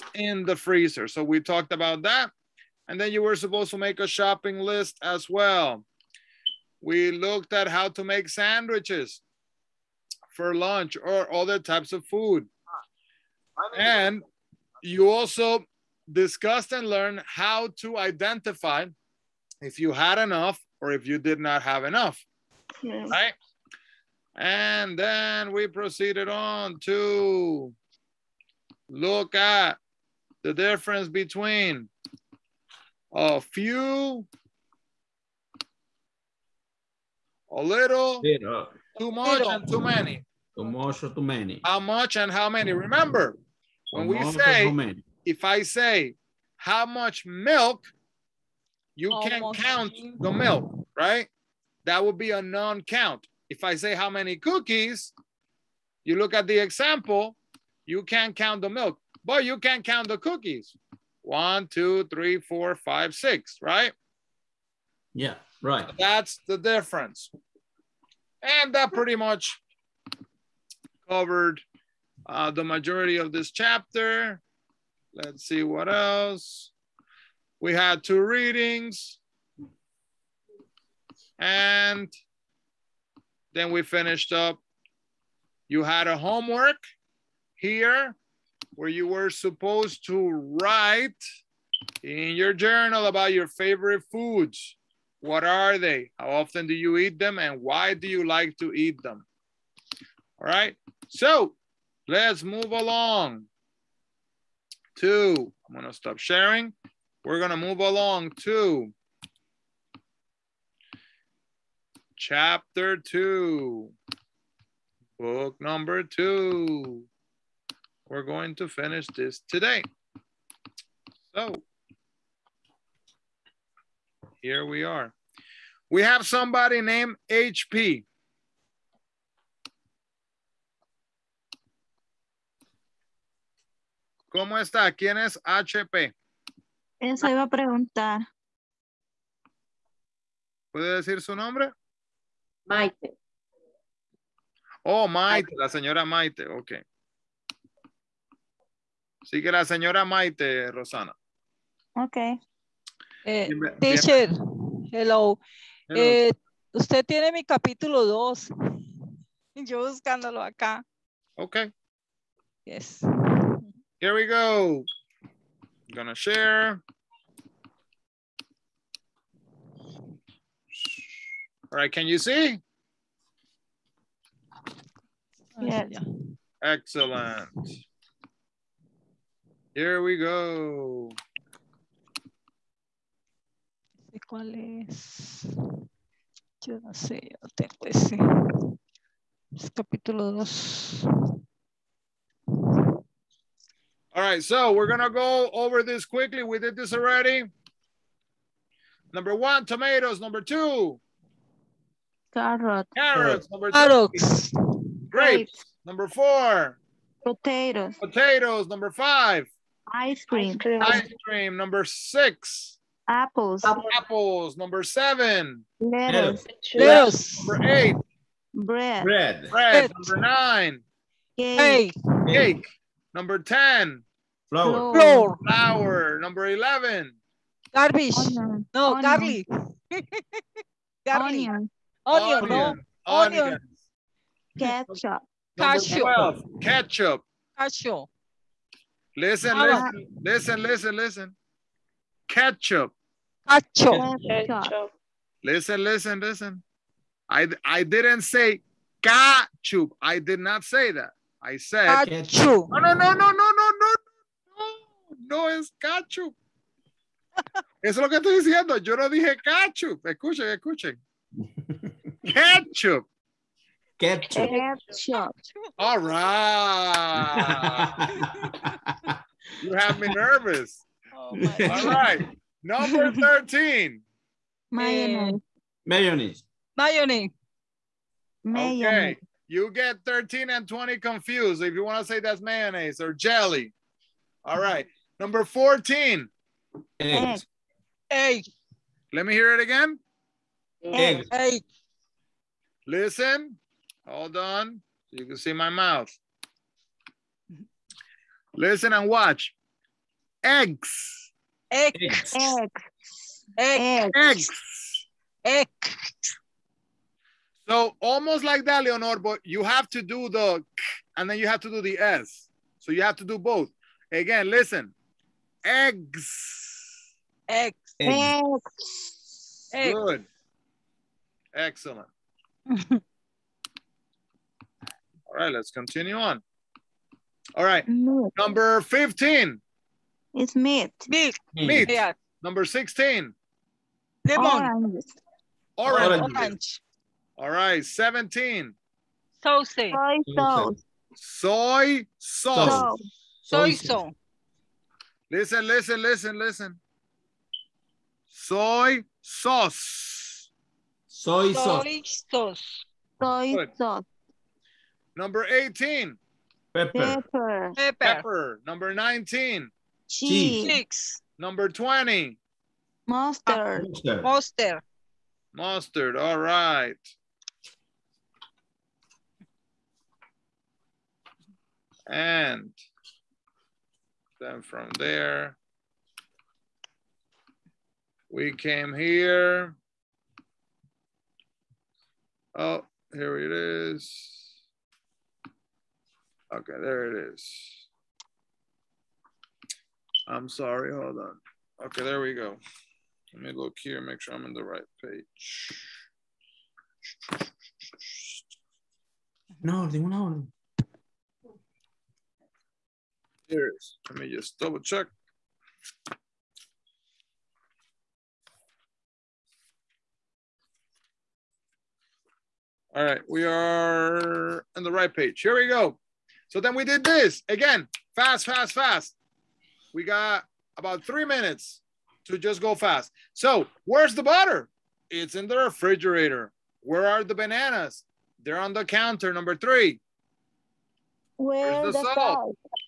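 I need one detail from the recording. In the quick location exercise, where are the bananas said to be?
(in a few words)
on the counter.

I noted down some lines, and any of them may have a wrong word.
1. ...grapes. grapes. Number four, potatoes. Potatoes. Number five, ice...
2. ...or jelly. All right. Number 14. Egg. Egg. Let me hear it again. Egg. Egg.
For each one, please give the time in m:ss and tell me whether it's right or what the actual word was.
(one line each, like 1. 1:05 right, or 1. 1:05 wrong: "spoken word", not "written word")
1. 3:24 right
2. 4:42 right.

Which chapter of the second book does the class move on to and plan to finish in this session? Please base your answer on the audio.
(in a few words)
chapter two.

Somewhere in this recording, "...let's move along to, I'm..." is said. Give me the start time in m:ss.
1:42.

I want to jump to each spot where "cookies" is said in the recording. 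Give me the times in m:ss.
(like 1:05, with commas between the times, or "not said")
0:54, 1:00.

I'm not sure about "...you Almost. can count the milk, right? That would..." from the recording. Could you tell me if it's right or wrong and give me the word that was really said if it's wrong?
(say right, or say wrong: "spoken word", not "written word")
right.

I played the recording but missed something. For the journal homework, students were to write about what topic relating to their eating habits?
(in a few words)
favorite foods.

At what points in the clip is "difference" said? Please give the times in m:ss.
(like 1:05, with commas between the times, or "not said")
0:30, 1:06.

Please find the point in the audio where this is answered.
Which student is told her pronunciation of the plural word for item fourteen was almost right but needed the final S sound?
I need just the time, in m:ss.
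5:08.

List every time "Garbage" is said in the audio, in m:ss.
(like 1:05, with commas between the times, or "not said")
3:47.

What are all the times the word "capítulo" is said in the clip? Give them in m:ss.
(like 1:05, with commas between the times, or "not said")
2:37, 3:09.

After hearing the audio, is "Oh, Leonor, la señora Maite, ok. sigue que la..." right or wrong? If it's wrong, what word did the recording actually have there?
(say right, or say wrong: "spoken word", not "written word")
wrong: "Maite", not "Leonor".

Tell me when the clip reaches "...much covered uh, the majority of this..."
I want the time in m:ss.
1:09.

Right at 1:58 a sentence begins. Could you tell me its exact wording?
We're going to finish this today.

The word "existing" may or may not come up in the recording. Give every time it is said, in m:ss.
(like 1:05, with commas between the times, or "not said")
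not said.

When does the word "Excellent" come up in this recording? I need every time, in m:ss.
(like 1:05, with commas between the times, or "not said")
2:56, 5:21.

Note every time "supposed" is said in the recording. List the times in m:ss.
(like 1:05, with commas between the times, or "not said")
0:03, 1:29.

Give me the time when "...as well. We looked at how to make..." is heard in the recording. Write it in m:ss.
0:05.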